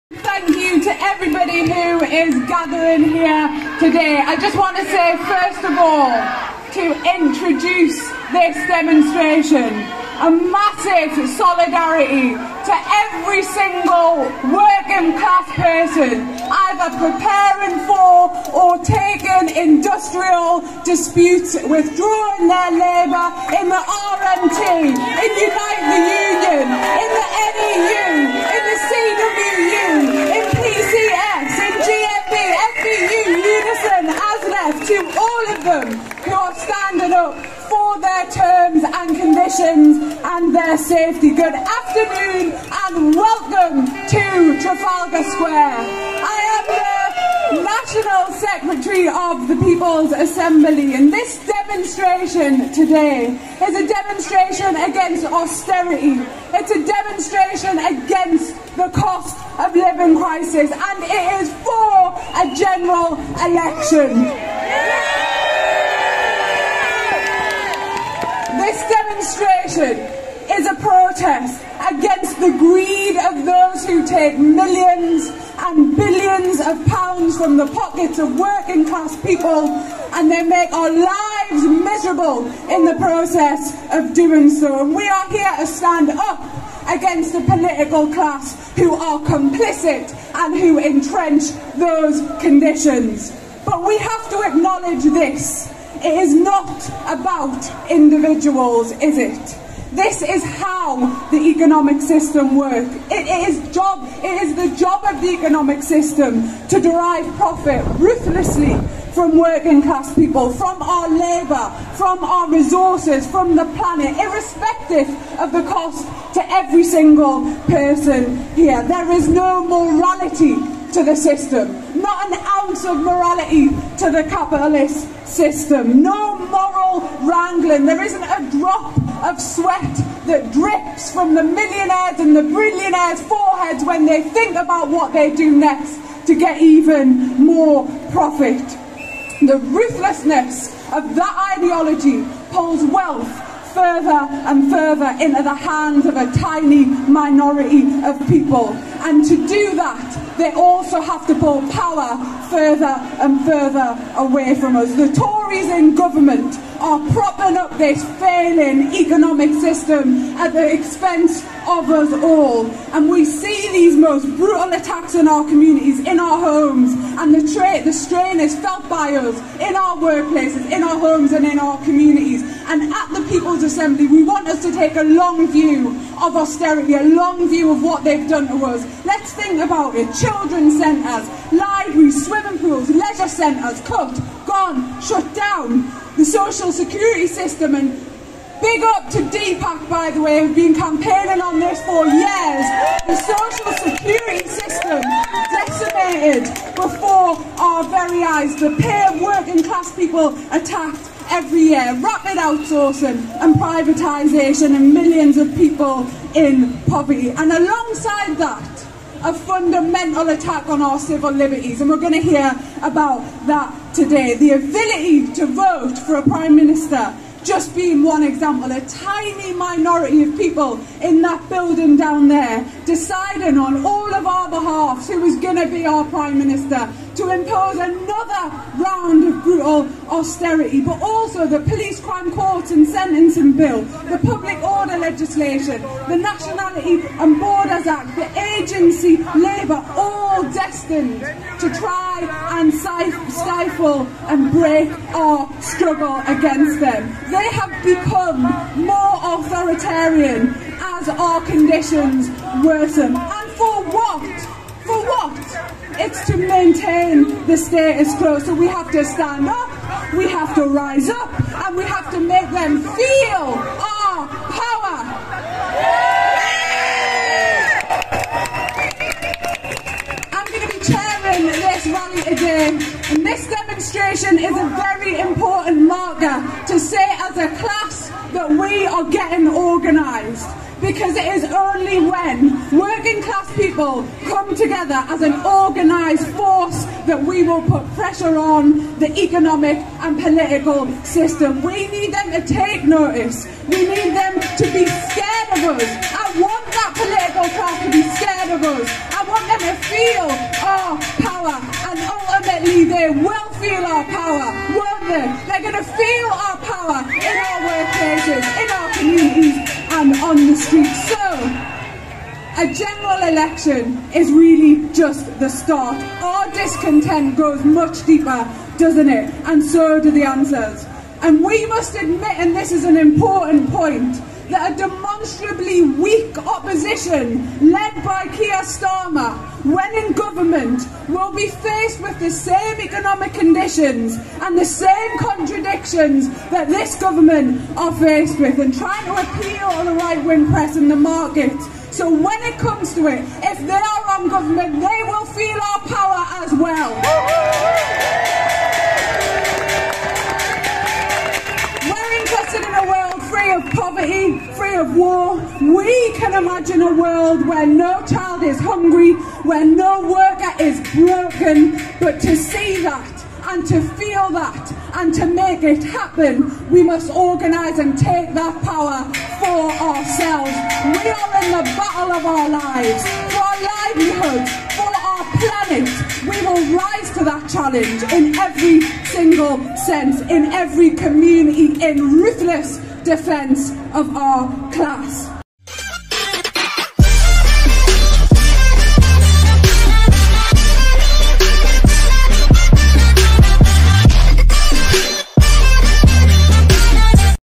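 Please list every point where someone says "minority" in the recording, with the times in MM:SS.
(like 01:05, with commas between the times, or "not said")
02:26, 03:39.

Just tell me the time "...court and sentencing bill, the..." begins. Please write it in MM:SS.
03:52.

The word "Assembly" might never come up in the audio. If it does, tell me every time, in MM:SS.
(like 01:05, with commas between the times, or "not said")
00:50, 02:53.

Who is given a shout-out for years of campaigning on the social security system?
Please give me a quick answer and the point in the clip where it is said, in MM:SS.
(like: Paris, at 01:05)
Deepak, at 03:09.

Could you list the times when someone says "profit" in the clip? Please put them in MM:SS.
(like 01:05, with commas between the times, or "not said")
01:47, 02:18.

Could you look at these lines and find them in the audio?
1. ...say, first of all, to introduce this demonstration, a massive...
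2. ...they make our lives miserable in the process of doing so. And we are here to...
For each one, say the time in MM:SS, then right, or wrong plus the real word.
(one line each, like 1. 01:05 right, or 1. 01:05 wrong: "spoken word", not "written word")
1. 00:04 right
2. 01:20 right.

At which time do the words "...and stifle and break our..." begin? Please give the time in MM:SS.
04:02.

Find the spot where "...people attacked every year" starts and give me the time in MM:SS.
03:19.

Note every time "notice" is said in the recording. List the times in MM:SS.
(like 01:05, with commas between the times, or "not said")
04:52.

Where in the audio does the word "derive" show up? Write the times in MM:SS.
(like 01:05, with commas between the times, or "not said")
01:46.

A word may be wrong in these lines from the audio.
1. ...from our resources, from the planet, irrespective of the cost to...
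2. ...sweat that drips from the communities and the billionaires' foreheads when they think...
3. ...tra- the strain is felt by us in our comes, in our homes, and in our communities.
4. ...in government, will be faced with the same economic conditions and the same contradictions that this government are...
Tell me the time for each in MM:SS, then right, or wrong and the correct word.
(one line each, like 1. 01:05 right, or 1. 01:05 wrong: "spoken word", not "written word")
1. 01:51 right
2. 02:09 wrong: "millionaires", not "communities"
3. 02:47 wrong: "workplaces", not "comes"
4. 05:30 right.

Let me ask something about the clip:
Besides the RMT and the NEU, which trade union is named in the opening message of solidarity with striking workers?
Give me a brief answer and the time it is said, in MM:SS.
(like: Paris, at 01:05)
Unite the Union, at 00:25.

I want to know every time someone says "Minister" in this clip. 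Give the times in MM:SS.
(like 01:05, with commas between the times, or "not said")
03:36, 03:46.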